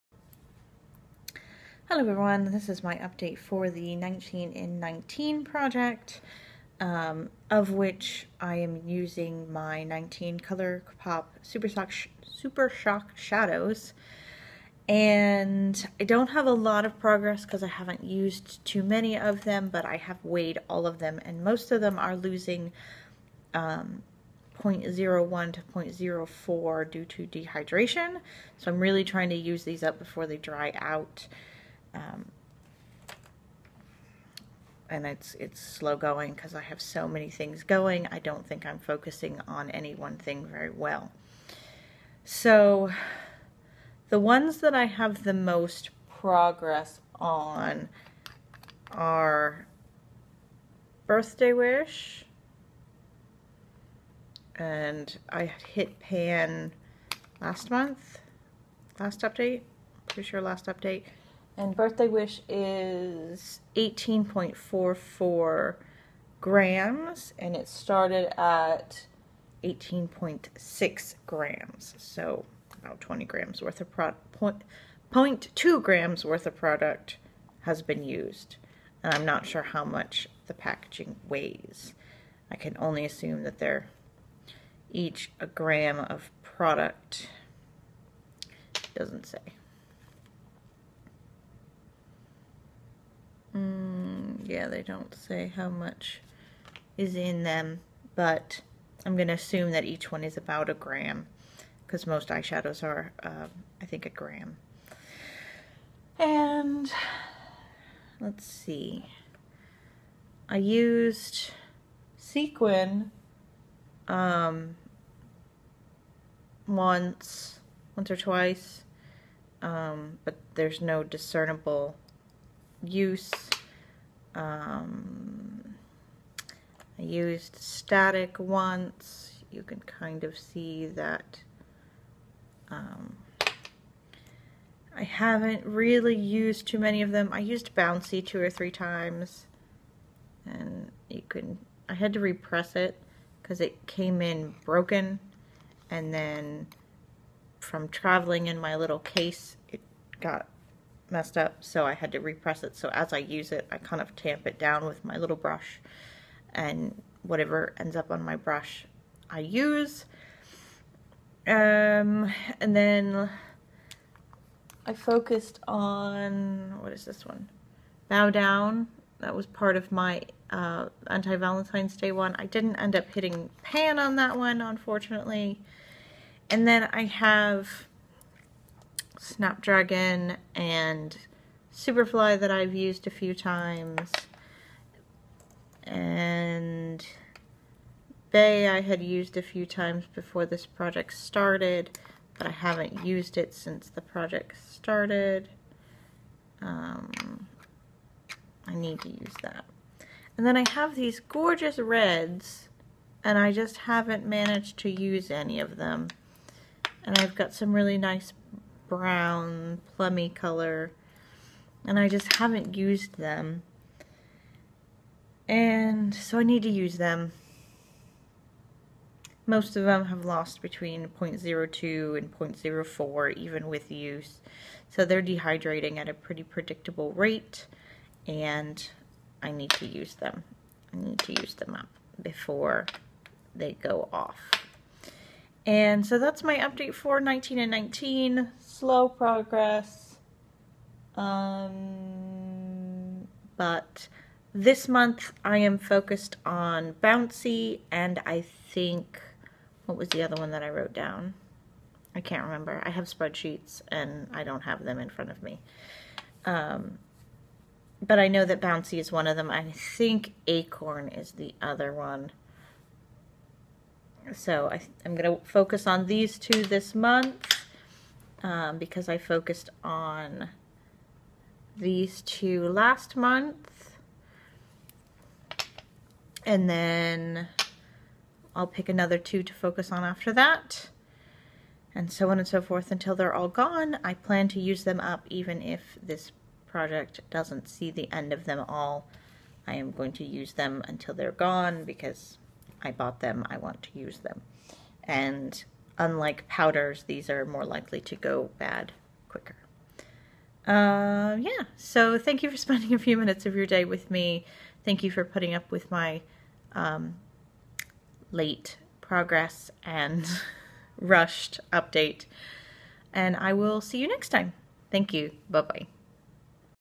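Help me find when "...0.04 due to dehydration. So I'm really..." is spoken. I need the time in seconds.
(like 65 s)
25 s.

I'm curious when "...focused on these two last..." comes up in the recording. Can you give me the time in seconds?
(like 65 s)
269 s.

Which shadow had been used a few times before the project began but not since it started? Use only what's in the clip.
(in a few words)
Bay.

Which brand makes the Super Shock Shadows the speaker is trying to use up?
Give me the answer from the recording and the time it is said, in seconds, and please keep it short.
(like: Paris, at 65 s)
Color Pop, at 10 s.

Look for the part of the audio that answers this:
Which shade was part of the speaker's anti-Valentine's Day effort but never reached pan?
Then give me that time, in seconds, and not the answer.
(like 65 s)
168 s.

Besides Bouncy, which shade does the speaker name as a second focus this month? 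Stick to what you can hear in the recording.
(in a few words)
Acorn.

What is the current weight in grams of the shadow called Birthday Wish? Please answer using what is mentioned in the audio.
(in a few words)
18.44 grams.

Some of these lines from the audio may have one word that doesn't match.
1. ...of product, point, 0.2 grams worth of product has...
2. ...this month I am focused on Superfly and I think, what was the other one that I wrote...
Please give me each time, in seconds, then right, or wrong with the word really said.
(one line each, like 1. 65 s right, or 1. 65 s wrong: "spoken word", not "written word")
1. 73 s right
2. 244 s wrong: "Bouncy", not "Superfly".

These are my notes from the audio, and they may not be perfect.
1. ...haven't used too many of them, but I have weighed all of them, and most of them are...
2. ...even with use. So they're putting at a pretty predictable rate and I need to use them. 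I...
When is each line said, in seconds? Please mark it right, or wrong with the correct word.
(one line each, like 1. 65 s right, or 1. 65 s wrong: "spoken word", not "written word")
1. 17 s right
2. 223 s wrong: "dehydrating", not "putting".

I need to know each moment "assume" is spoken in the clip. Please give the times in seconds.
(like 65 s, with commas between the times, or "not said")
83 s, 99 s.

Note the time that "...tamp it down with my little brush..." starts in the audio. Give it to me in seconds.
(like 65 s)
154 s.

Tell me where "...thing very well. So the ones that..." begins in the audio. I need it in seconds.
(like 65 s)
40 s.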